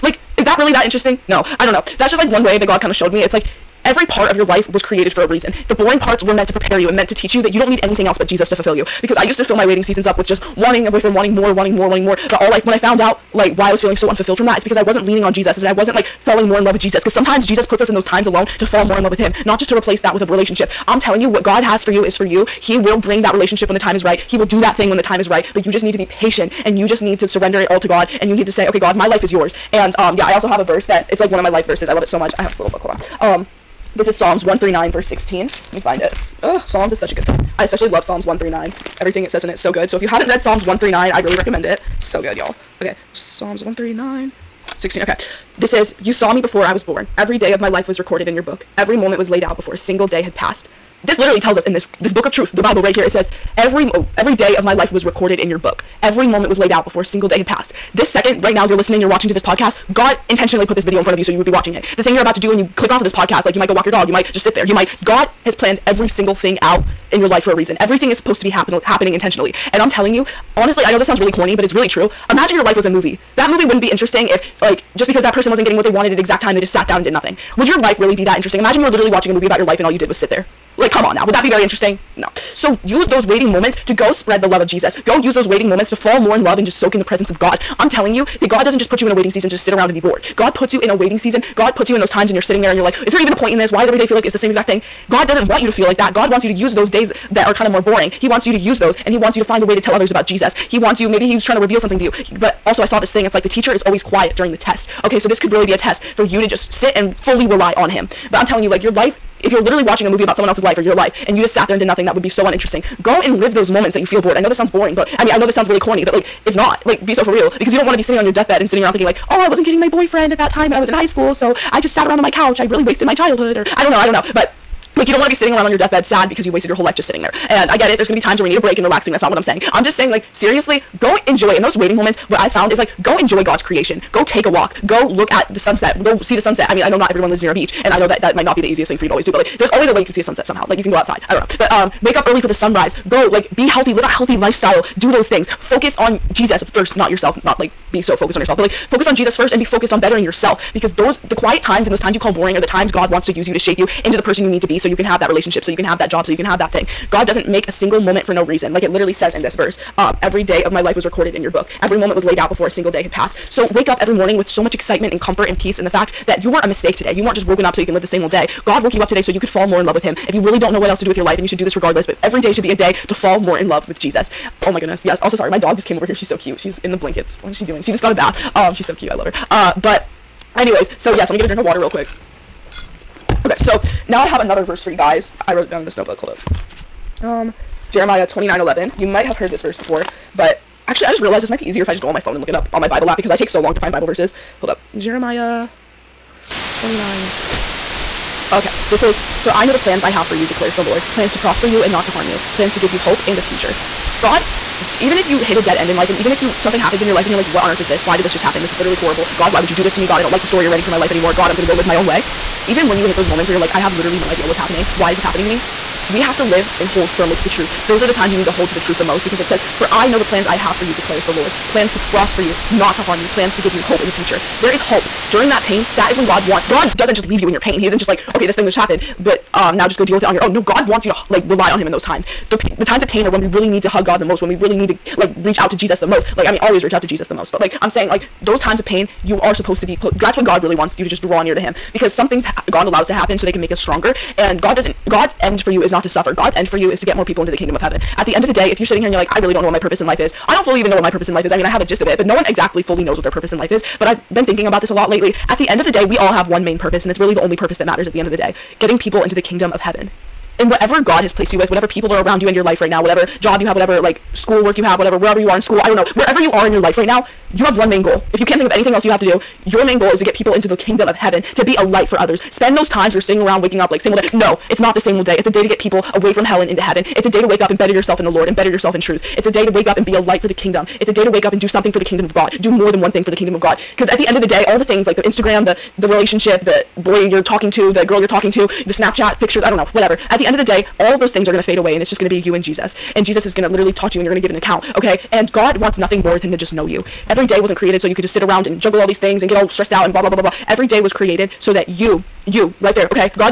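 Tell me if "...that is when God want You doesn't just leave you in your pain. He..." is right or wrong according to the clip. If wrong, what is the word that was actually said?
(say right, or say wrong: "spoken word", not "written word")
wrong: "God", not "You".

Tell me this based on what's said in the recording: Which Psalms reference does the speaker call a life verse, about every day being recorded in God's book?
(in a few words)
Psalms 139:16.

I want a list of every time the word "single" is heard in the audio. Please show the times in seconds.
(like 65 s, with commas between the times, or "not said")
49 s, 57 s, 66 s, 157 s, 162 s.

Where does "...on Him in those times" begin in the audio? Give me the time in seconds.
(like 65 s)
231 s.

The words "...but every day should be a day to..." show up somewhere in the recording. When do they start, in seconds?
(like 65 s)
172 s.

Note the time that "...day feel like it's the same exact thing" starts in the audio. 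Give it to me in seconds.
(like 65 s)
93 s.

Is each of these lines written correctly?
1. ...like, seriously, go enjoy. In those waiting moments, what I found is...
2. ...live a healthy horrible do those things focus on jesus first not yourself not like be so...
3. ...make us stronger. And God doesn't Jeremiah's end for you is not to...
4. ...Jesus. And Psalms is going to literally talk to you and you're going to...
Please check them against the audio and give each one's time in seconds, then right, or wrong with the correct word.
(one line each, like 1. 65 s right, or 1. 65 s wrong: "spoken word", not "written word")
1. 130 s right
2. 143 s wrong: "lifestyle", not "horrible"
3. 243 s wrong: "God", not "Jeremiah"
4. 292 s wrong: "Jesus", not "Psalms".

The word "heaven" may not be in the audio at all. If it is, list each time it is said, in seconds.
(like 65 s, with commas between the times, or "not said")
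247 s, 259 s, 271 s, 276 s.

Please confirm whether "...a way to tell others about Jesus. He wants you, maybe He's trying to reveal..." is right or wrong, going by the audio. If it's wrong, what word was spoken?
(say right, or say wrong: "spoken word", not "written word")
right.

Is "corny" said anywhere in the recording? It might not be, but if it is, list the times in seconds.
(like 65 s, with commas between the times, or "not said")
71 s, 115 s.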